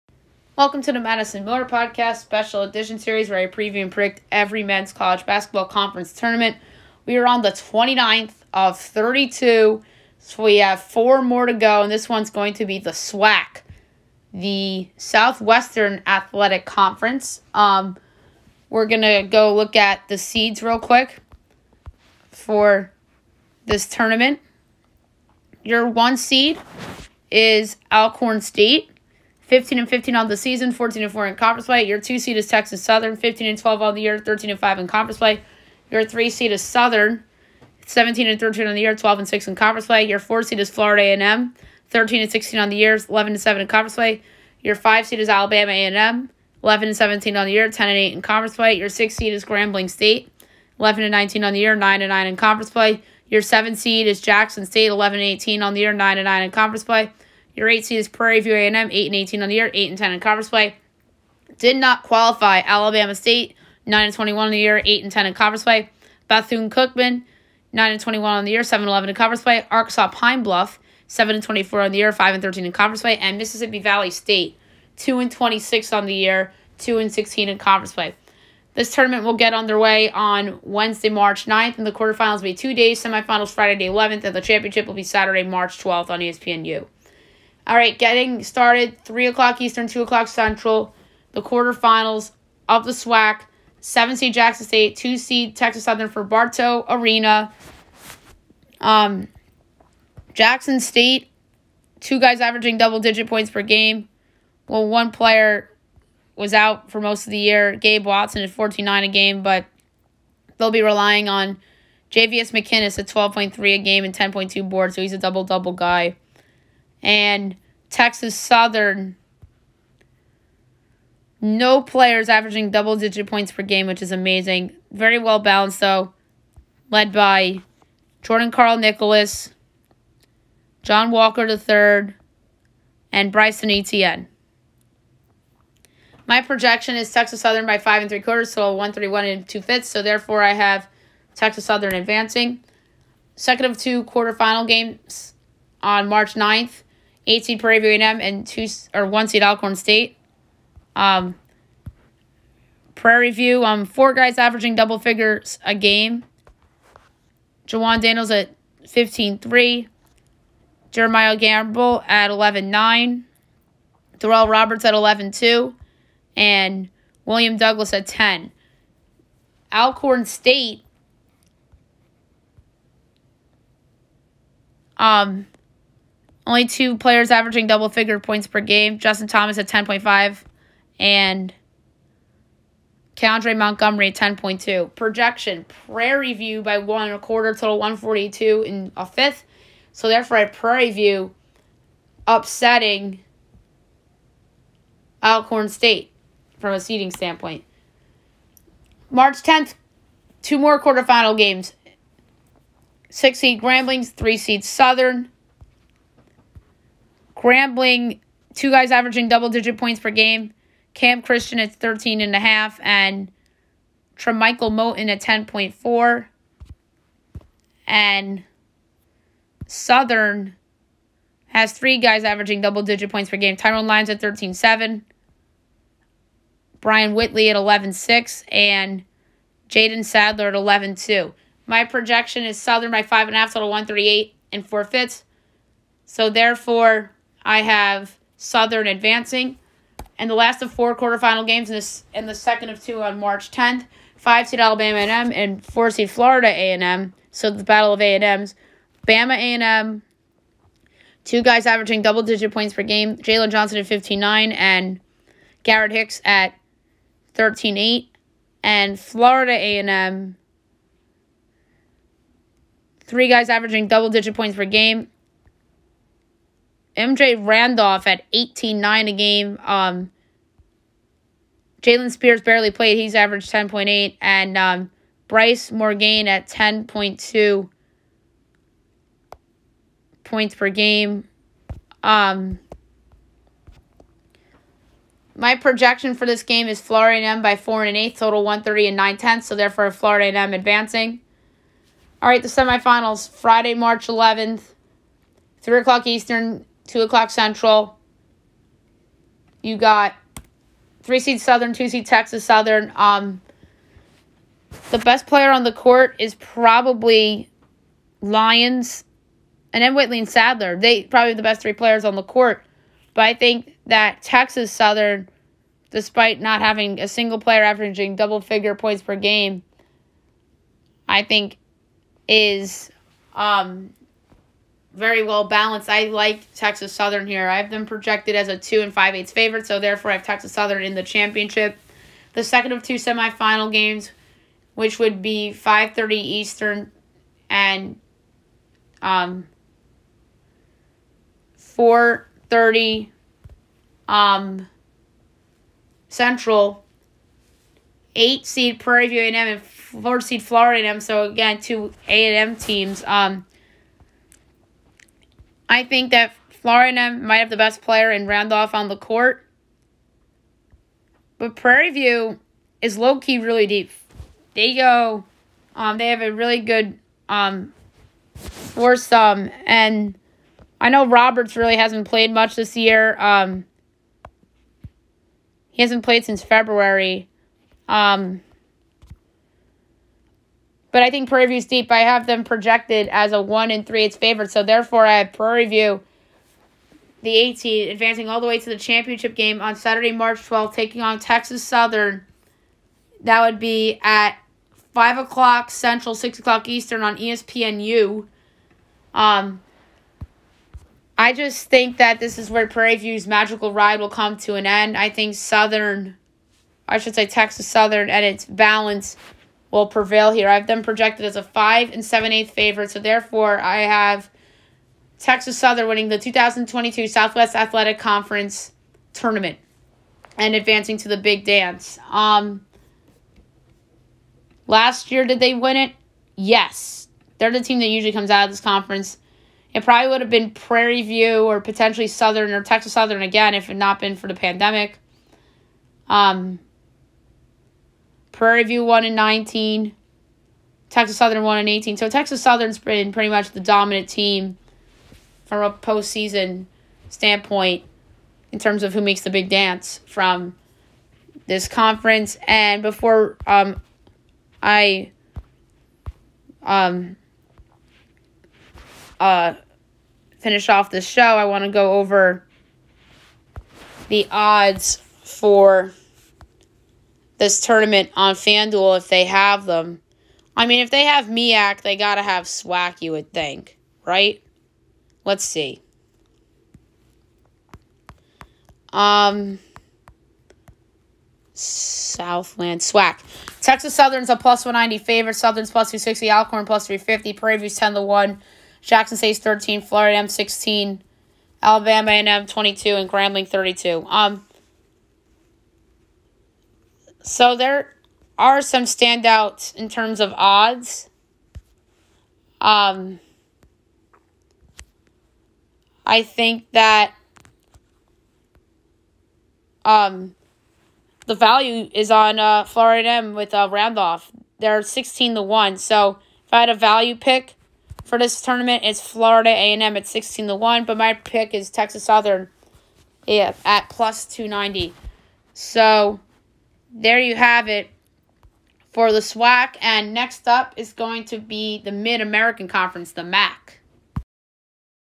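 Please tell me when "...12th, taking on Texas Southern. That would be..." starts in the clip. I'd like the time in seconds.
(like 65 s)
390 s.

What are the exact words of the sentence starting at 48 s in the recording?
Your six seed is Grambling State, 11 and 19 on the year, 9 and 9 in conference play.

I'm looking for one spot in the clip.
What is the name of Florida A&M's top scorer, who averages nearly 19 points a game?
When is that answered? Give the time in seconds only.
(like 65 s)
266 s.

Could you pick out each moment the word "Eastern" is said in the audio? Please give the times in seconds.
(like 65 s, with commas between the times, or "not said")
89 s, 296 s, 336 s, 396 s.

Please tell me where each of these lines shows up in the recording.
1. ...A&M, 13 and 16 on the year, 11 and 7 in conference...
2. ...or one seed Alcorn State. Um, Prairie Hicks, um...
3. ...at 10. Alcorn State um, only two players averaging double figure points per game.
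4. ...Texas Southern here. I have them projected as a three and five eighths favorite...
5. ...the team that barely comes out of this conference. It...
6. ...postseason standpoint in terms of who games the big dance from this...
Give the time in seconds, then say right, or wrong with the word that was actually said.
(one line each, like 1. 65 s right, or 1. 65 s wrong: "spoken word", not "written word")
1. 41 s right
2. 148 s wrong: "View", not "Hicks"
3. 167 s right
4. 326 s wrong: "two", not "three"
5. 427 s wrong: "usually", not "barely"
6. 445 s wrong: "makes", not "games".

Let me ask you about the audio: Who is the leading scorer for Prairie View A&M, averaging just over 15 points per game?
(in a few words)
Jawan Daniels.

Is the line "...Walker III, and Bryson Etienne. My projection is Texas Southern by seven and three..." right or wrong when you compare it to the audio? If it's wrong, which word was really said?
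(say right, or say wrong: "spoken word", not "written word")
wrong: "five", not "seven".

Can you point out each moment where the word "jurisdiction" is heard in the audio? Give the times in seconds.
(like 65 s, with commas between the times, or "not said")
not said.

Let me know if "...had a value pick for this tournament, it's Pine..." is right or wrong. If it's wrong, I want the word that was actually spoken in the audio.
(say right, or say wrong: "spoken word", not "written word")
wrong: "Florida", not "Pine".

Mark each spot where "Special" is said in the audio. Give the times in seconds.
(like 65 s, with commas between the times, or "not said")
2 s.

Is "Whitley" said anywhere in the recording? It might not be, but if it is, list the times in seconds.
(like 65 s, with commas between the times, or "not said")
227 s, 309 s.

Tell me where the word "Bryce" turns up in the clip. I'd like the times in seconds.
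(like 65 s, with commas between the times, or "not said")
275 s.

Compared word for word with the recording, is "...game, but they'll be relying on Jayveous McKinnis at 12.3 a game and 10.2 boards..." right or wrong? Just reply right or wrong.
right.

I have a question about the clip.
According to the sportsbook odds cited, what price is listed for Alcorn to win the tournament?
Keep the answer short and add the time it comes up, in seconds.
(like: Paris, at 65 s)
+350, at 486 s.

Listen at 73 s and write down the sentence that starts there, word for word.
And Mississippi Valley State, 2 and 26 on the year, 2 and 16 in conference play.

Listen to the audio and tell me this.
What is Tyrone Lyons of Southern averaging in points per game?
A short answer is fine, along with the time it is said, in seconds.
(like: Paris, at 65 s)
13.7, at 224 s.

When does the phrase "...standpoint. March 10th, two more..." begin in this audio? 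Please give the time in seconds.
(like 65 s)
197 s.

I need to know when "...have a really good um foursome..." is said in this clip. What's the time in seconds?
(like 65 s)
366 s.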